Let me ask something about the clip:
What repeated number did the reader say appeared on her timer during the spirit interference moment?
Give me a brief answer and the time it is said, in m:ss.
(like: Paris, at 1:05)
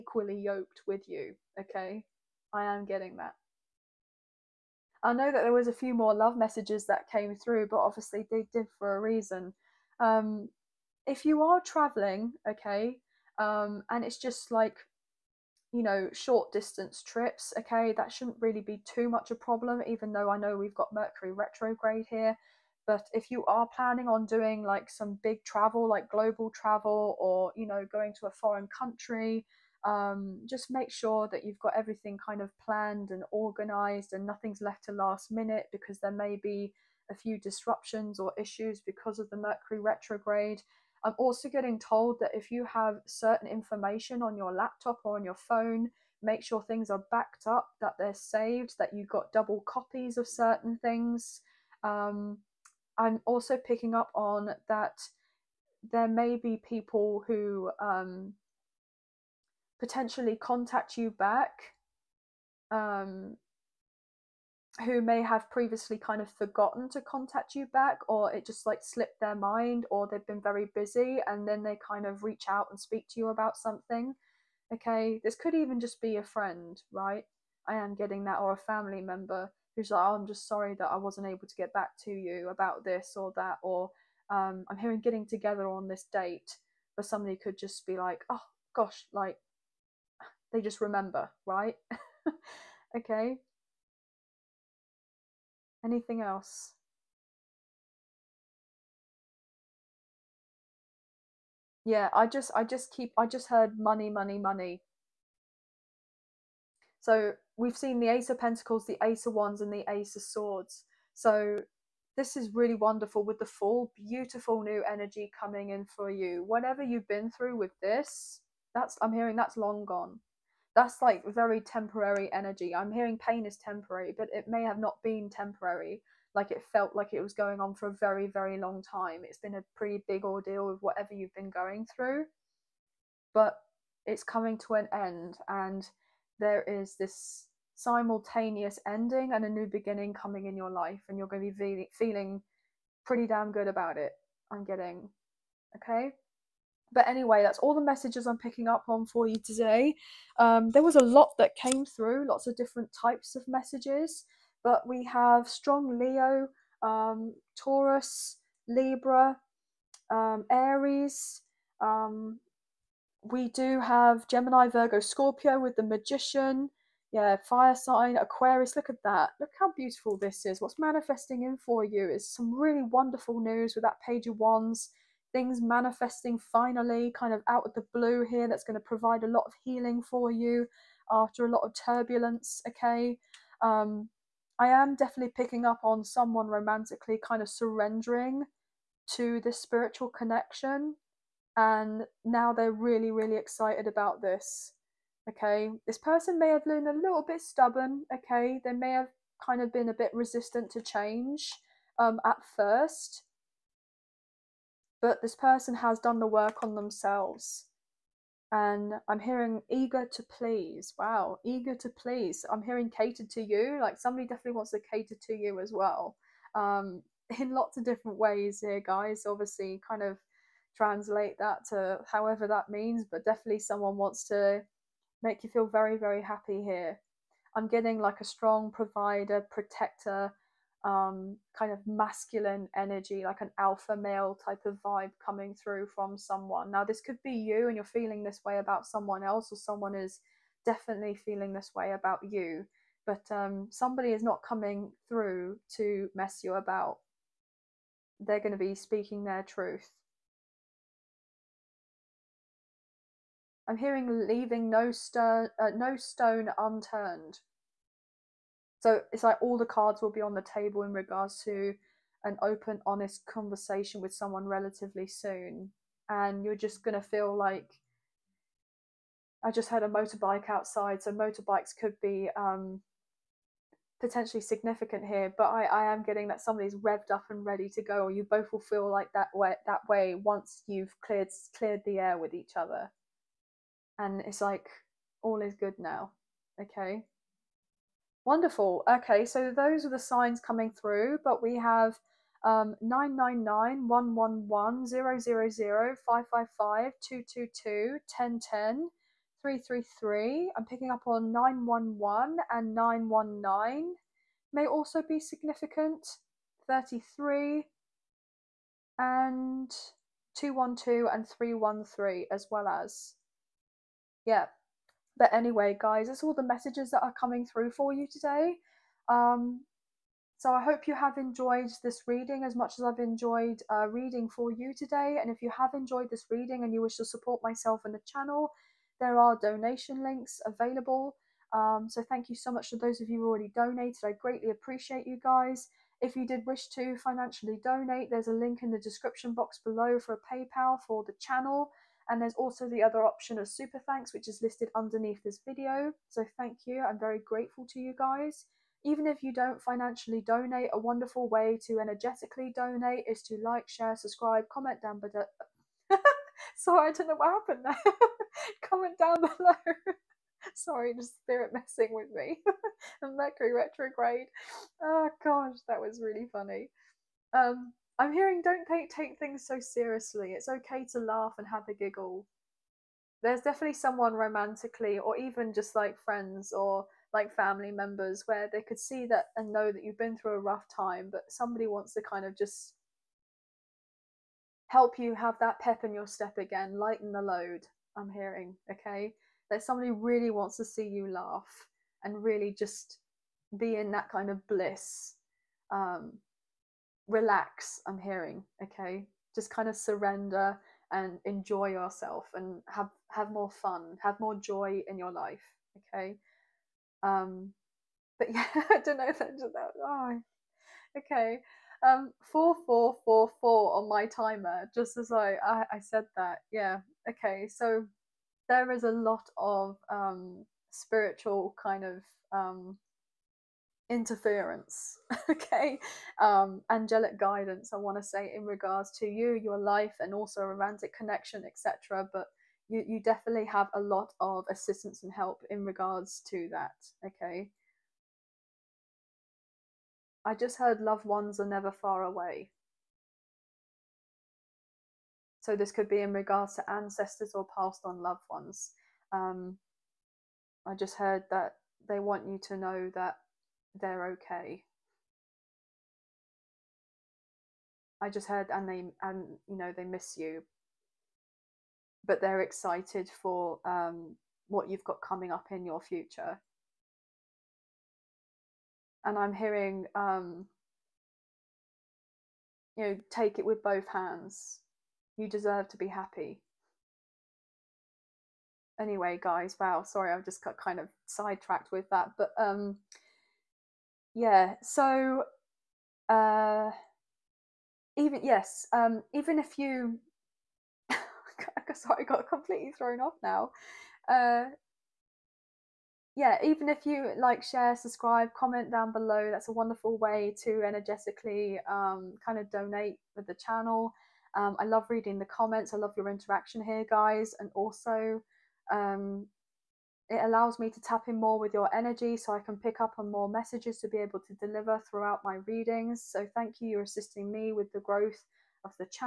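4444, at 6:52.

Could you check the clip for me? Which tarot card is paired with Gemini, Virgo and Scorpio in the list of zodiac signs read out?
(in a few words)
The Magician.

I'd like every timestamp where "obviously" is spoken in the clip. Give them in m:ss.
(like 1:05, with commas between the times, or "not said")
0:07, 3:39.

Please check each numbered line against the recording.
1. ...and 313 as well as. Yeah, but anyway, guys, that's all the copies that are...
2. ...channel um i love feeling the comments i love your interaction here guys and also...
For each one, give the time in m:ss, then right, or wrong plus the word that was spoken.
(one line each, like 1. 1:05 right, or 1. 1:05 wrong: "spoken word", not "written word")
1. 5:11 wrong: "messages", not "copies"
2. 8:23 wrong: "reading", not "feeling".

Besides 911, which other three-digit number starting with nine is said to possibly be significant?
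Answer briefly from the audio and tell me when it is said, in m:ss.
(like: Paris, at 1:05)
919, at 5:02.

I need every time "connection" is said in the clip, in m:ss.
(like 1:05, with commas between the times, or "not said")
3:10, 7:10.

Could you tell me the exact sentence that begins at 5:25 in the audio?
And if you have enjoyed this reading and you wish to support myself and the channel, there are donation links available.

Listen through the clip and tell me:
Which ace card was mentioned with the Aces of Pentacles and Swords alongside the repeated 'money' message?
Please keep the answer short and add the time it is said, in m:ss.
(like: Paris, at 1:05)
Ace of Wands, at 1:48.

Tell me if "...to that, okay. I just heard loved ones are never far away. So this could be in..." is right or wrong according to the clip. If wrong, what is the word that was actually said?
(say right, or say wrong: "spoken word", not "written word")
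right.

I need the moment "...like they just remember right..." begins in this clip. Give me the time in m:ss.
1:29.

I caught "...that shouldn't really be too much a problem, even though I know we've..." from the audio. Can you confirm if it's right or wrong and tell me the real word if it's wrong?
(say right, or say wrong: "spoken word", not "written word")
right.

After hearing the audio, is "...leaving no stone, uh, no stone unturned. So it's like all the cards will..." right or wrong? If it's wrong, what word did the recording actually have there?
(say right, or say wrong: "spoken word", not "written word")
right.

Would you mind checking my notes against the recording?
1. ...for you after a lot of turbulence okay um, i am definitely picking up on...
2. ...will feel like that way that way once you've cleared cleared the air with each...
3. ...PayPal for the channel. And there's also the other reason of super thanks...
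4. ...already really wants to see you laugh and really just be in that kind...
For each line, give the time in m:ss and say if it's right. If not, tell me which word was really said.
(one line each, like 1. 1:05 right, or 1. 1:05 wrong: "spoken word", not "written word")
1. 3:00 right
2. 4:38 right
3. 5:40 wrong: "option", not "reason"
4. 6:29 wrong: "somebody", not "already".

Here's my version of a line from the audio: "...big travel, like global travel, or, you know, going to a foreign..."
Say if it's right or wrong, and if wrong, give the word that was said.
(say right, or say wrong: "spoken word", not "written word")
right.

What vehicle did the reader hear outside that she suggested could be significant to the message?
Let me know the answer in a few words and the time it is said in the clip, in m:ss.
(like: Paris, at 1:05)
Motorbike, at 4:29.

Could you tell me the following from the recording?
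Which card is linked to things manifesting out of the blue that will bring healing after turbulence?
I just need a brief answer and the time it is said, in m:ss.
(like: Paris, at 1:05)
Page of Wands, at 2:54.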